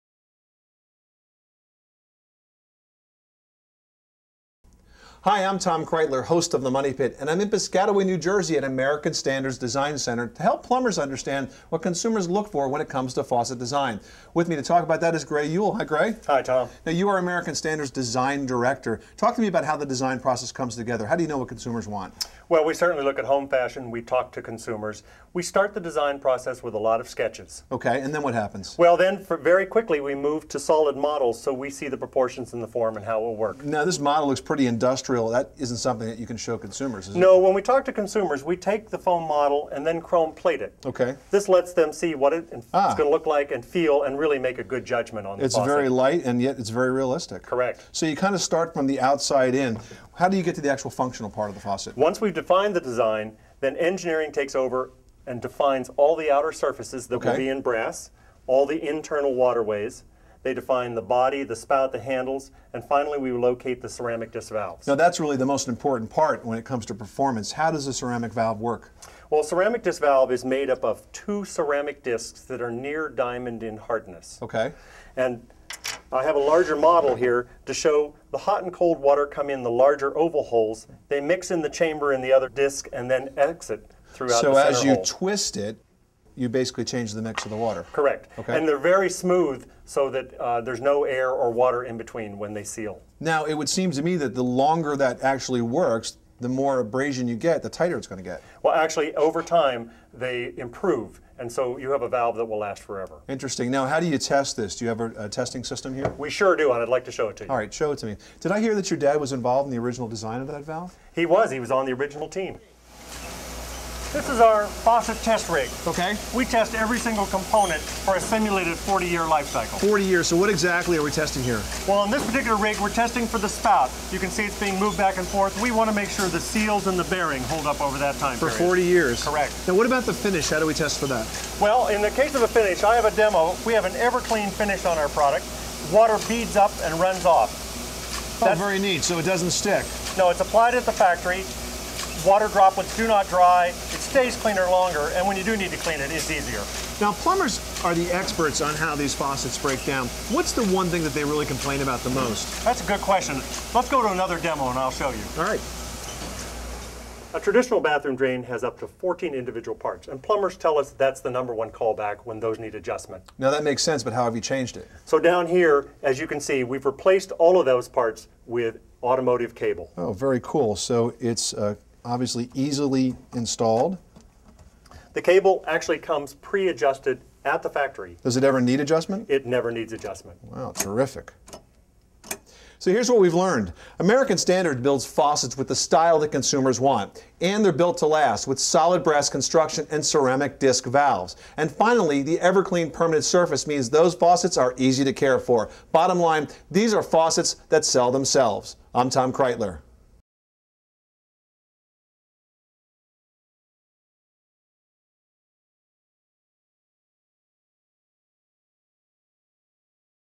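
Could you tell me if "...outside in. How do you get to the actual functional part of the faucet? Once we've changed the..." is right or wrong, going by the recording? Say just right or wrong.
wrong.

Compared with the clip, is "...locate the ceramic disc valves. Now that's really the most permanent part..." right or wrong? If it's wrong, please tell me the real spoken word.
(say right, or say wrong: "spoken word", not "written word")
wrong: "important", not "permanent".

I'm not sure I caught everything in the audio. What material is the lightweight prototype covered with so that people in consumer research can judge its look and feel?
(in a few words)
chrome plate.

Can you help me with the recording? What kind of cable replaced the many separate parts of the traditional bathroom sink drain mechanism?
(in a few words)
automotive cable.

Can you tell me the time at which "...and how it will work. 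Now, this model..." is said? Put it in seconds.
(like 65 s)
32 s.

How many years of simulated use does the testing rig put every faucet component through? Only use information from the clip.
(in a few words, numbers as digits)
40.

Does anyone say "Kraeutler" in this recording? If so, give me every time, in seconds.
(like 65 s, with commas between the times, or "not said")
5 s, 199 s.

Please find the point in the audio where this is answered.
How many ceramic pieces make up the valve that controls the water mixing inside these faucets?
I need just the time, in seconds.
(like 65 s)
71 s.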